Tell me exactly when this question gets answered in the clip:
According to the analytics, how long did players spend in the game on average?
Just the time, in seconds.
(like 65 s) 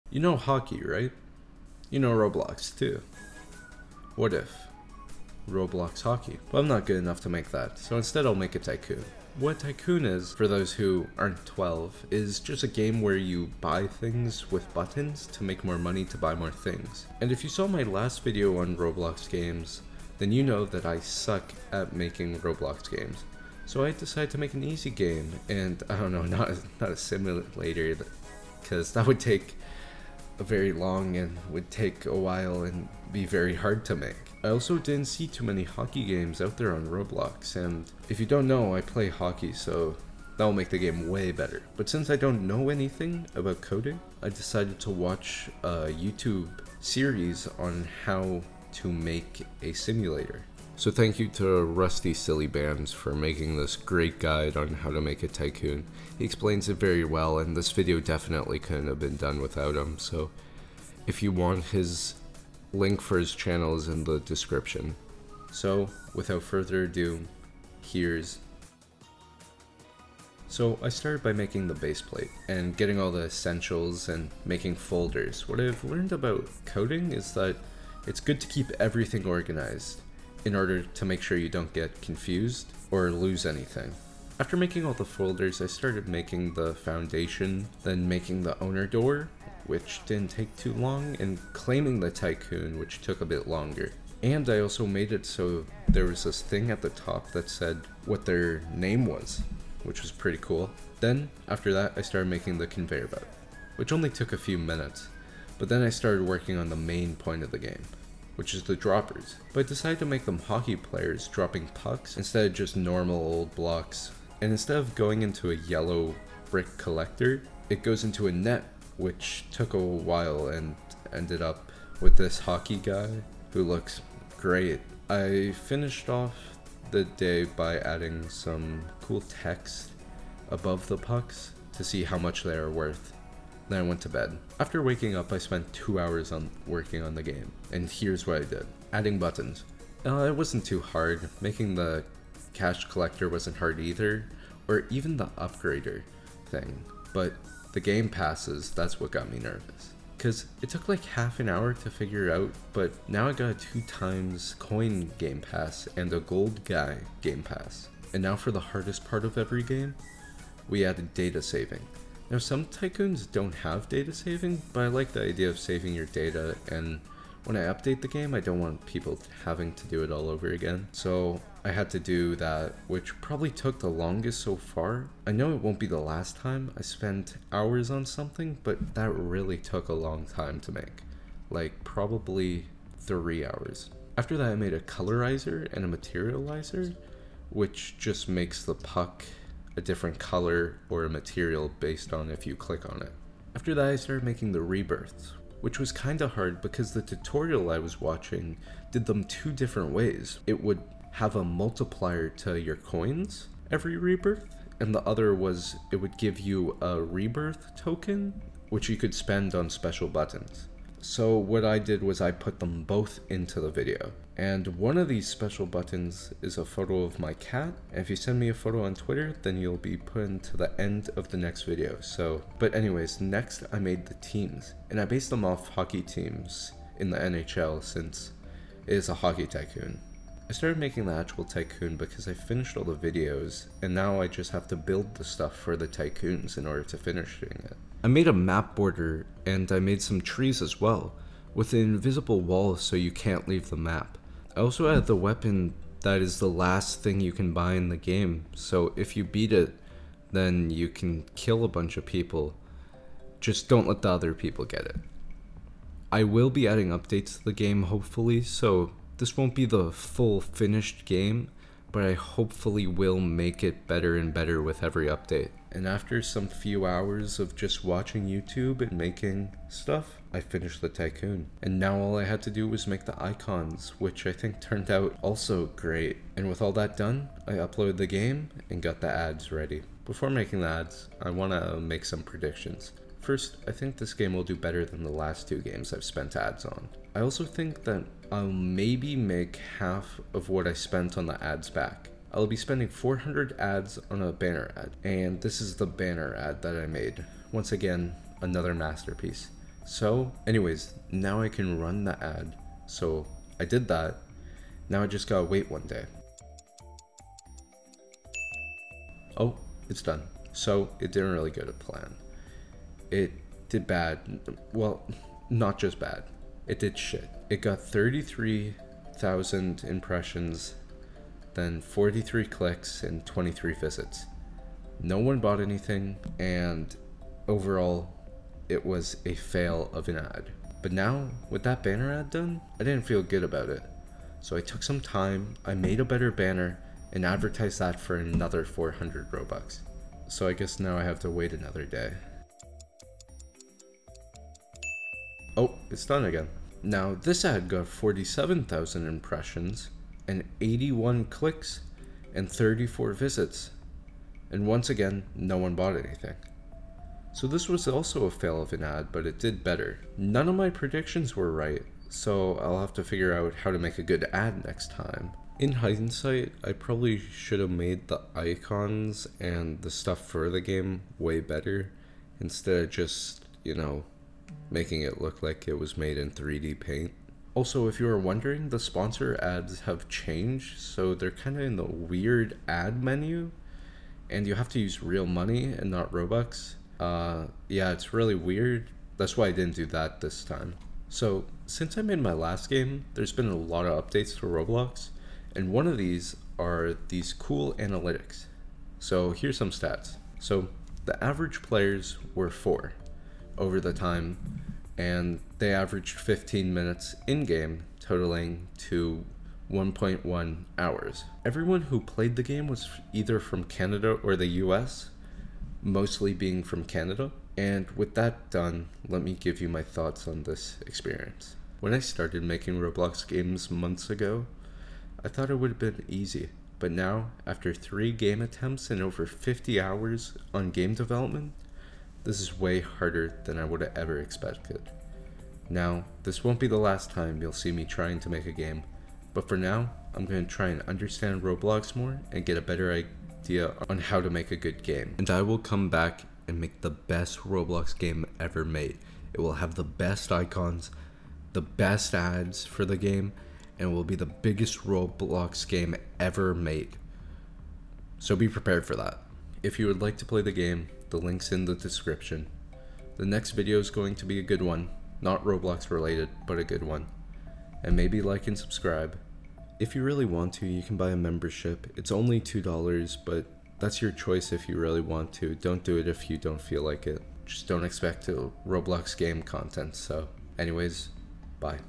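406 s.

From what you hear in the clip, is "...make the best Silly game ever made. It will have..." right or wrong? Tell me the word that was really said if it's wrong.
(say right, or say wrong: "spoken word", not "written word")
wrong: "Roblox", not "Silly".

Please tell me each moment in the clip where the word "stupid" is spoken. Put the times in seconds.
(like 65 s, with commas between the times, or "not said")
not said.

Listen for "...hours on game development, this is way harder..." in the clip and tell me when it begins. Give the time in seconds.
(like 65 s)
429 s.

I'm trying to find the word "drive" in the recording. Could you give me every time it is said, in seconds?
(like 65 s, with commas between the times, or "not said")
not said.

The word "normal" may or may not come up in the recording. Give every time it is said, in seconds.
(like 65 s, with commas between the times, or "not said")
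112 s.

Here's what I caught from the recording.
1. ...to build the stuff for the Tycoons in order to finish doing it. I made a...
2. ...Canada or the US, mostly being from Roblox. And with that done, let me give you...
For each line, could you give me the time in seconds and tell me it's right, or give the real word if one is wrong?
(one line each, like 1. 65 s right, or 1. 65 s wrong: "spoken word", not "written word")
1. 234 s right
2. 413 s wrong: "Canada", not "Roblox".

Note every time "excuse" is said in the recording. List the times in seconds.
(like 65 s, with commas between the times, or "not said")
not said.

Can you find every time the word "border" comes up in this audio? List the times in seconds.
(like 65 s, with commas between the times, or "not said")
238 s.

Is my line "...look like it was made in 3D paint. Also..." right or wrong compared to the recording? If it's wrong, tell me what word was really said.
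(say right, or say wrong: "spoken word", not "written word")
right.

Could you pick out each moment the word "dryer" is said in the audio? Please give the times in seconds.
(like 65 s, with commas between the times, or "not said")
not said.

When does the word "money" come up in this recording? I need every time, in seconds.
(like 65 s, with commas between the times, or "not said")
15 s, 385 s.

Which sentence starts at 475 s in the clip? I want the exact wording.
Don't do it if you don't feel like it.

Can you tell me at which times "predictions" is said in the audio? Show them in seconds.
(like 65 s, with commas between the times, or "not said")
282 s, 360 s.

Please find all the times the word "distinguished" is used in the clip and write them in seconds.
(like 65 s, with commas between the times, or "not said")
not said.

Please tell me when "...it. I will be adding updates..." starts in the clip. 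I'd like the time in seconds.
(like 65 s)
254 s.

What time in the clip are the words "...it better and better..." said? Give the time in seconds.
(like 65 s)
263 s.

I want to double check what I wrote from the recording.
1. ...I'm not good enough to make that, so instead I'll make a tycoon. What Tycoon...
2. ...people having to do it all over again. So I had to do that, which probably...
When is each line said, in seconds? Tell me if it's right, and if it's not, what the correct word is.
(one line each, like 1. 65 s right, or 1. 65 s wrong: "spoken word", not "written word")
1. 6 s right
2. 168 s right.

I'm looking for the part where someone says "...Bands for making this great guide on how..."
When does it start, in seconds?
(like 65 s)
52 s.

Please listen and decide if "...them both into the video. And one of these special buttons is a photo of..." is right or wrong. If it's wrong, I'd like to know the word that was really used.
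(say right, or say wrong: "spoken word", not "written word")
right.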